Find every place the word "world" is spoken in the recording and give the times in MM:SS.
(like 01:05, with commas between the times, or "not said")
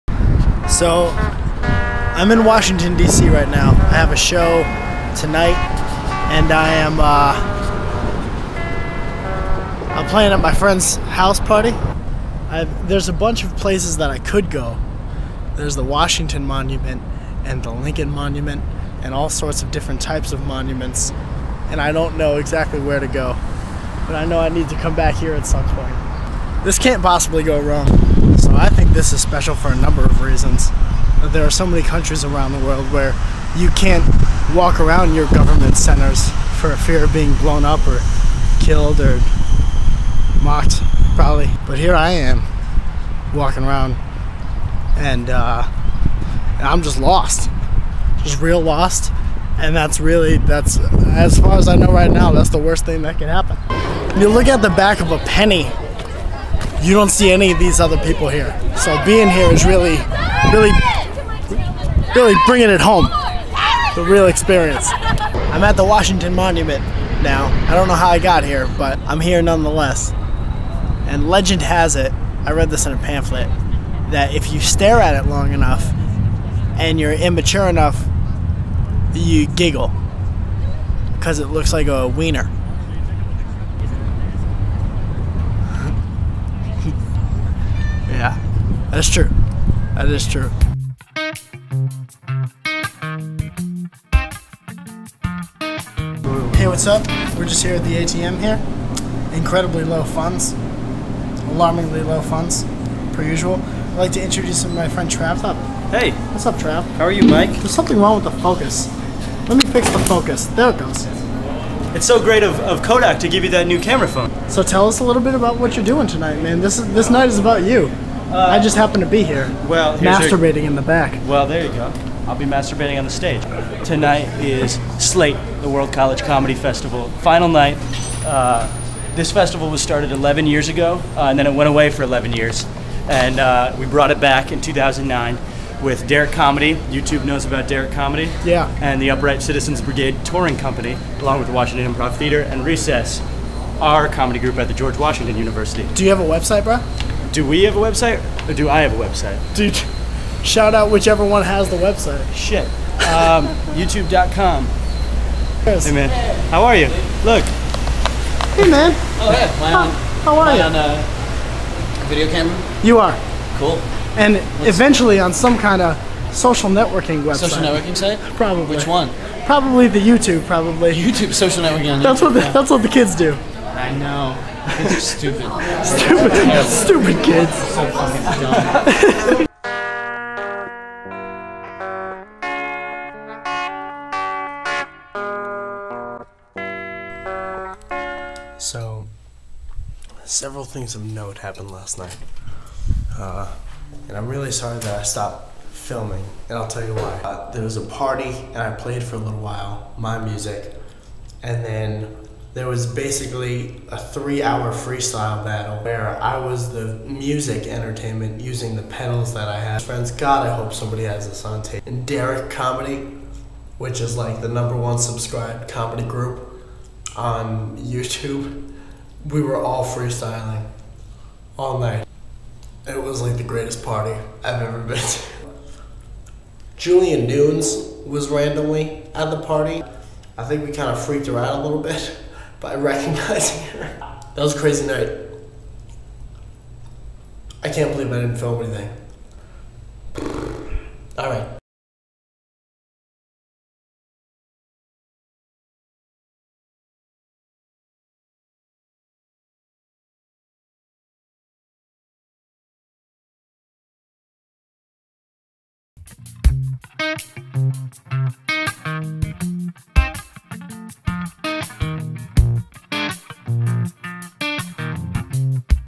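00:32, 02:05.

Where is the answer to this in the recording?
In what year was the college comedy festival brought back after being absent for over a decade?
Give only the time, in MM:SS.
02:14.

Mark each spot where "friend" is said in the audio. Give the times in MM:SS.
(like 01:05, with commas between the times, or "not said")
00:10, 01:44, 03:29.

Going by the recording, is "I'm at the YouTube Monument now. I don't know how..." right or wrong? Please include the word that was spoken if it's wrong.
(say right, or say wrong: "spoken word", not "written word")
wrong: "Washington", not "YouTube".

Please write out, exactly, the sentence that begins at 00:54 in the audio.
You look at the back of a penny you don't see any of these other people here.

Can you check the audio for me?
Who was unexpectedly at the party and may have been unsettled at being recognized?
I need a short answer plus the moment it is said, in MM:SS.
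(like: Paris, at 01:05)
Julia Nunes, at 03:46.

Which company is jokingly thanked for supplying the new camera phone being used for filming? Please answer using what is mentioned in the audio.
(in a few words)
Kodak.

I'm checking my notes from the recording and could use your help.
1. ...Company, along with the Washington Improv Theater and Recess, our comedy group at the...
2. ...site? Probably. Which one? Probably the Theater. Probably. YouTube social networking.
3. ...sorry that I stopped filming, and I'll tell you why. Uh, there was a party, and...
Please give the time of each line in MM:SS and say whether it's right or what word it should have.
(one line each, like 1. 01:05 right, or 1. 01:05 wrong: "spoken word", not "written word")
1. 02:20 right
2. 02:47 wrong: "YouTube", not "Theater"
3. 03:14 right.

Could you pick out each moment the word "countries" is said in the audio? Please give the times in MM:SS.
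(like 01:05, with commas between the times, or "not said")
00:31.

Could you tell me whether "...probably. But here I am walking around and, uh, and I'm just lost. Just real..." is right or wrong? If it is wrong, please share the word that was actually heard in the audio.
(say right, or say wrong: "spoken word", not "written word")
right.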